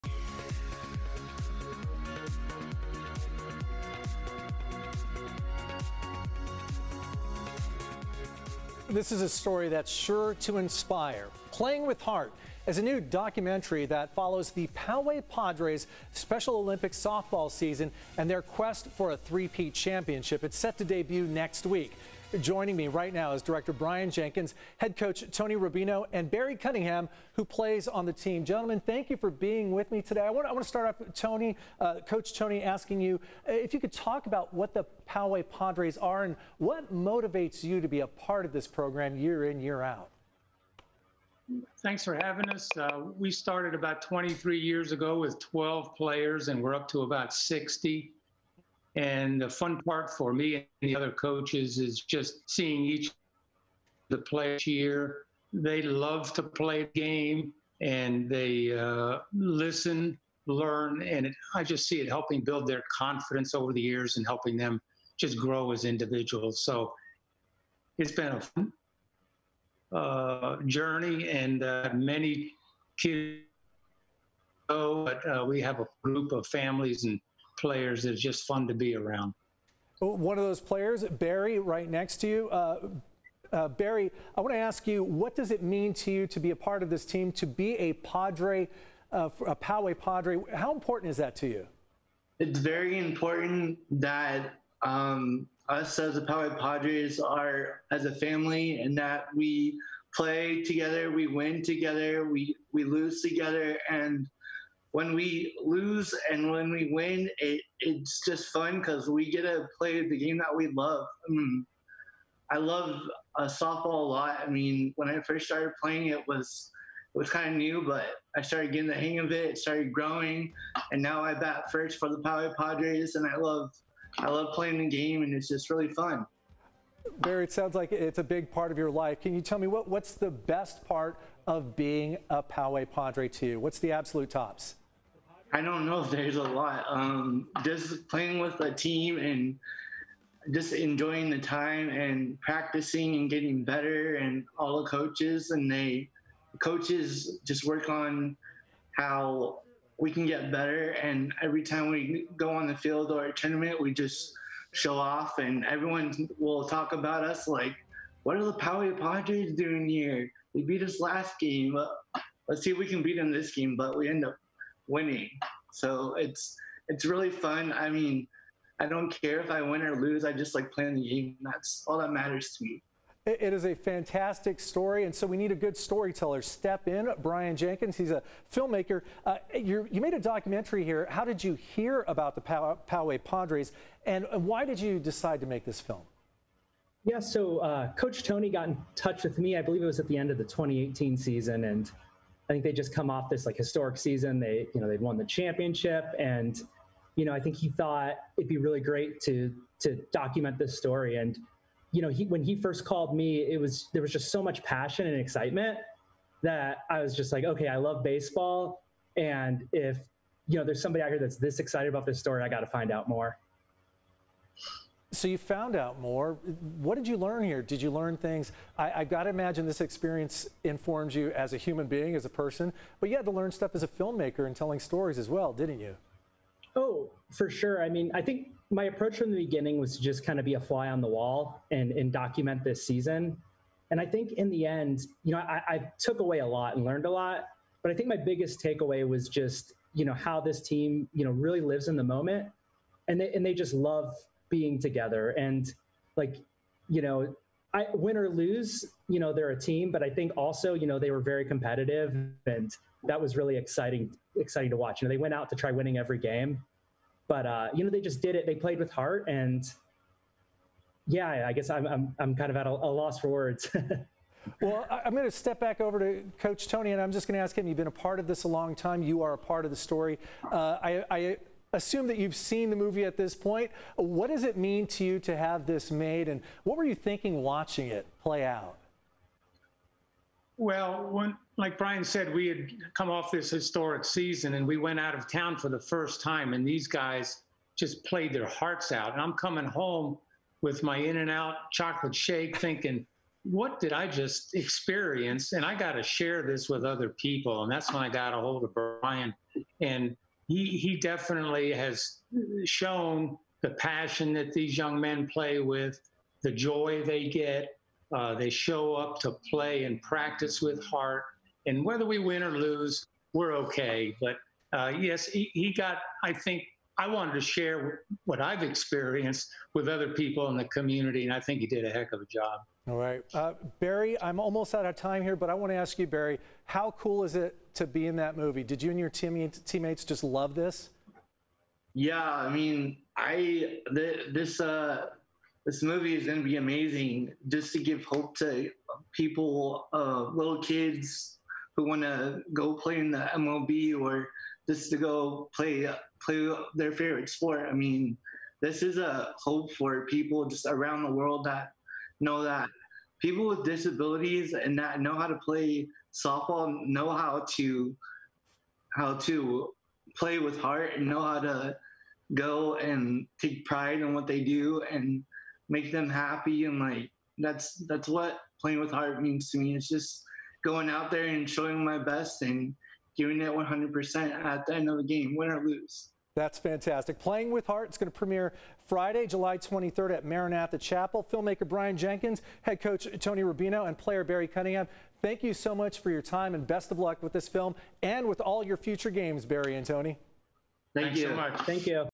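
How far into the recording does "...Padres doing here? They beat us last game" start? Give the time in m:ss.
2:38.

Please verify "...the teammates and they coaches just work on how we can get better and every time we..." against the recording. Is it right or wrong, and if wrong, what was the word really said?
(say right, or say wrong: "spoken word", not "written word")
wrong: "coaches", not "teammates".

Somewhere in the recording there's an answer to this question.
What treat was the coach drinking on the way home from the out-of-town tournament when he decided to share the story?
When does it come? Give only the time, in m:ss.
4:50.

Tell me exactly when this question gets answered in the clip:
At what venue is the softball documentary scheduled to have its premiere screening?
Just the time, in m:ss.
6:20.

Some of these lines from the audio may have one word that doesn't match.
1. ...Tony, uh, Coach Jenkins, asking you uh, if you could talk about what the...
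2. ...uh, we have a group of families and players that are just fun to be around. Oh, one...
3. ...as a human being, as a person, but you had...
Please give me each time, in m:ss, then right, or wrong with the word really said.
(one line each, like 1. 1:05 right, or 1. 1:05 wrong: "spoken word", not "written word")
1. 0:31 wrong: "Tony", not "Jenkins"
2. 1:15 right
3. 3:41 right.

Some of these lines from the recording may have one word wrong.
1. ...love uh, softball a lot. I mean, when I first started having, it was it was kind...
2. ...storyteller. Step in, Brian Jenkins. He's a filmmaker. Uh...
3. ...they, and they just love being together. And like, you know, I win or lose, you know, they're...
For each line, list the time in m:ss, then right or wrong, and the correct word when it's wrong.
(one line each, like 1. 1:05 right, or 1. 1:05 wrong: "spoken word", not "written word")
1. 1:52 wrong: "playing", not "having"
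2. 2:55 right
3. 4:03 right.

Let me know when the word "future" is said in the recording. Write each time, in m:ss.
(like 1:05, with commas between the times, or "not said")
6:28.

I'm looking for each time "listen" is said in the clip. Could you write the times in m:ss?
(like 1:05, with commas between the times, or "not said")
0:59.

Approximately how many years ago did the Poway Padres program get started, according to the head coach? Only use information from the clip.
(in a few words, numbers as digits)
23.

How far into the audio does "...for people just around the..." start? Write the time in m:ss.
5:49.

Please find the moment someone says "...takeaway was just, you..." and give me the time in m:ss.
3:58.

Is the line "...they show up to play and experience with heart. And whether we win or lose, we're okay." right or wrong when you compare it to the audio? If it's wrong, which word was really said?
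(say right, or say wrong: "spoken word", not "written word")
wrong: "practice", not "experience".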